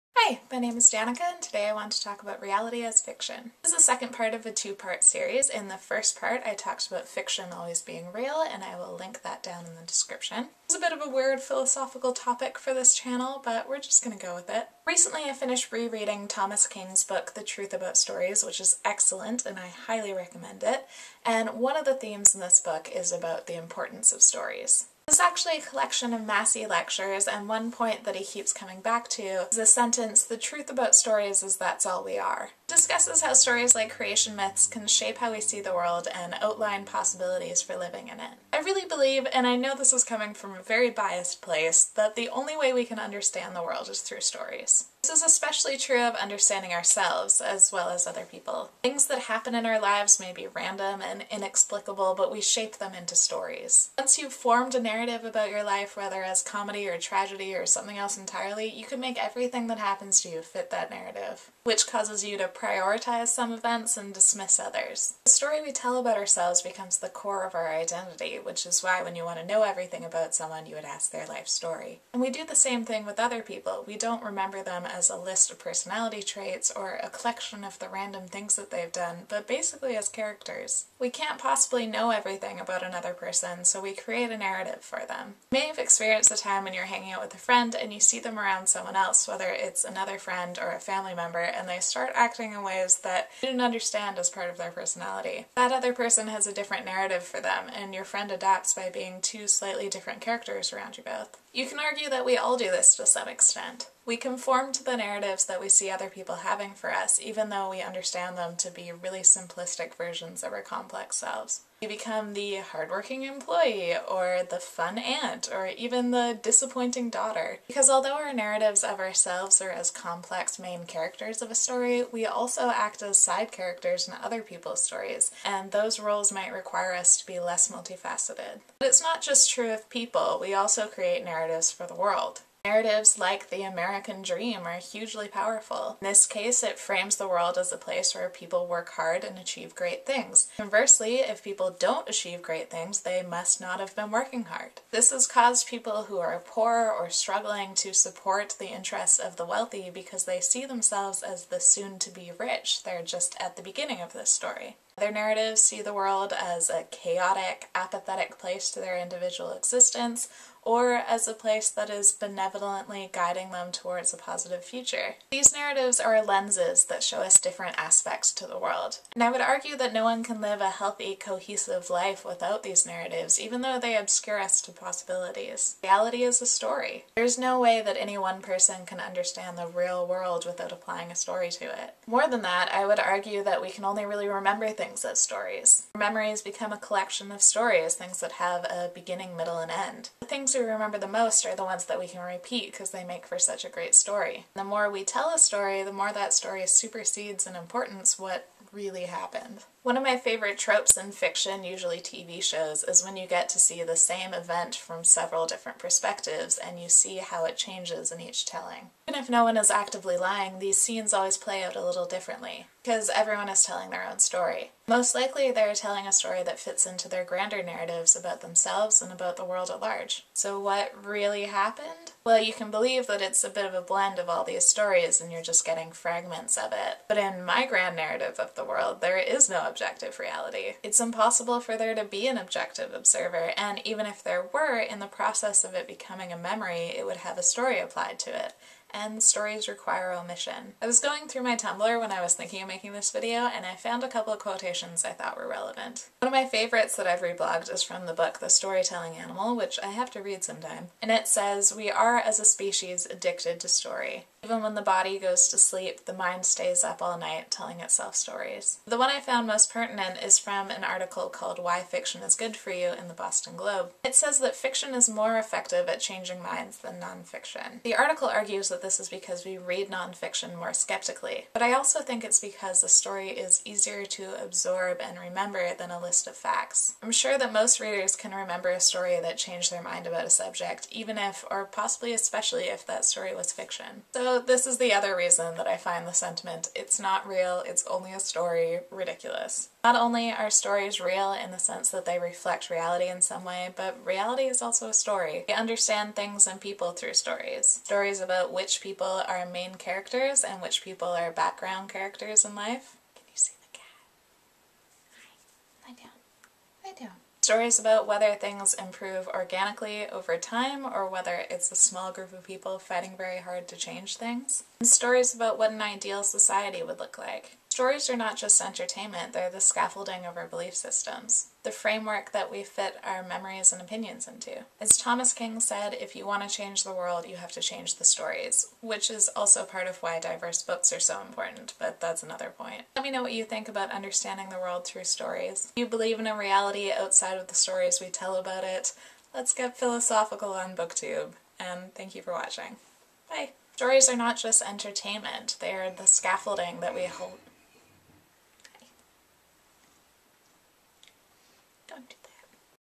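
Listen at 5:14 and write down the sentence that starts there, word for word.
And stories about what an ideal society would look like.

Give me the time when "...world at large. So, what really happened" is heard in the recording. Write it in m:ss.
3:39.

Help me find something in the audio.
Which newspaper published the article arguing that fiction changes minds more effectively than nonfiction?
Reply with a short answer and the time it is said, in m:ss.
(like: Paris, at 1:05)
Boston Globe, at 4:23.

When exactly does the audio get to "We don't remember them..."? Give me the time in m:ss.
1:13.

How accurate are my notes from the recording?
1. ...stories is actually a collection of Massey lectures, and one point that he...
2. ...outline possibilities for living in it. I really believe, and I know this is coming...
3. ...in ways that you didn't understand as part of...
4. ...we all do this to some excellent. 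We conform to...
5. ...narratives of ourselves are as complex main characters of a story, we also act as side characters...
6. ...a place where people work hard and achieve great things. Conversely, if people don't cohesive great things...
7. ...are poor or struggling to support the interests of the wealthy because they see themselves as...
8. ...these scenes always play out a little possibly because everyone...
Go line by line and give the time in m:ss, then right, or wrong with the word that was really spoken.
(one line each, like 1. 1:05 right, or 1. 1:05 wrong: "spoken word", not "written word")
1. 0:24 right
2. 0:36 right
3. 1:32 right
4. 1:42 wrong: "extent", not "excellent"
5. 1:58 right
6. 2:17 wrong: "achieve", not "cohesive"
7. 2:26 right
8. 3:30 wrong: "differently", not "possibly".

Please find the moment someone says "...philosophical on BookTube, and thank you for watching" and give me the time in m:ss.
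5:39.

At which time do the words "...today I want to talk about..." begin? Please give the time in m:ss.
0:01.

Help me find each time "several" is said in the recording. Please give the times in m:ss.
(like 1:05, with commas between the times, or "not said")
3:25.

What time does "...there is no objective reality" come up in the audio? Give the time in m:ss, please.
3:48.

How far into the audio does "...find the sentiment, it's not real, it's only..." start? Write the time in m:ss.
4:45.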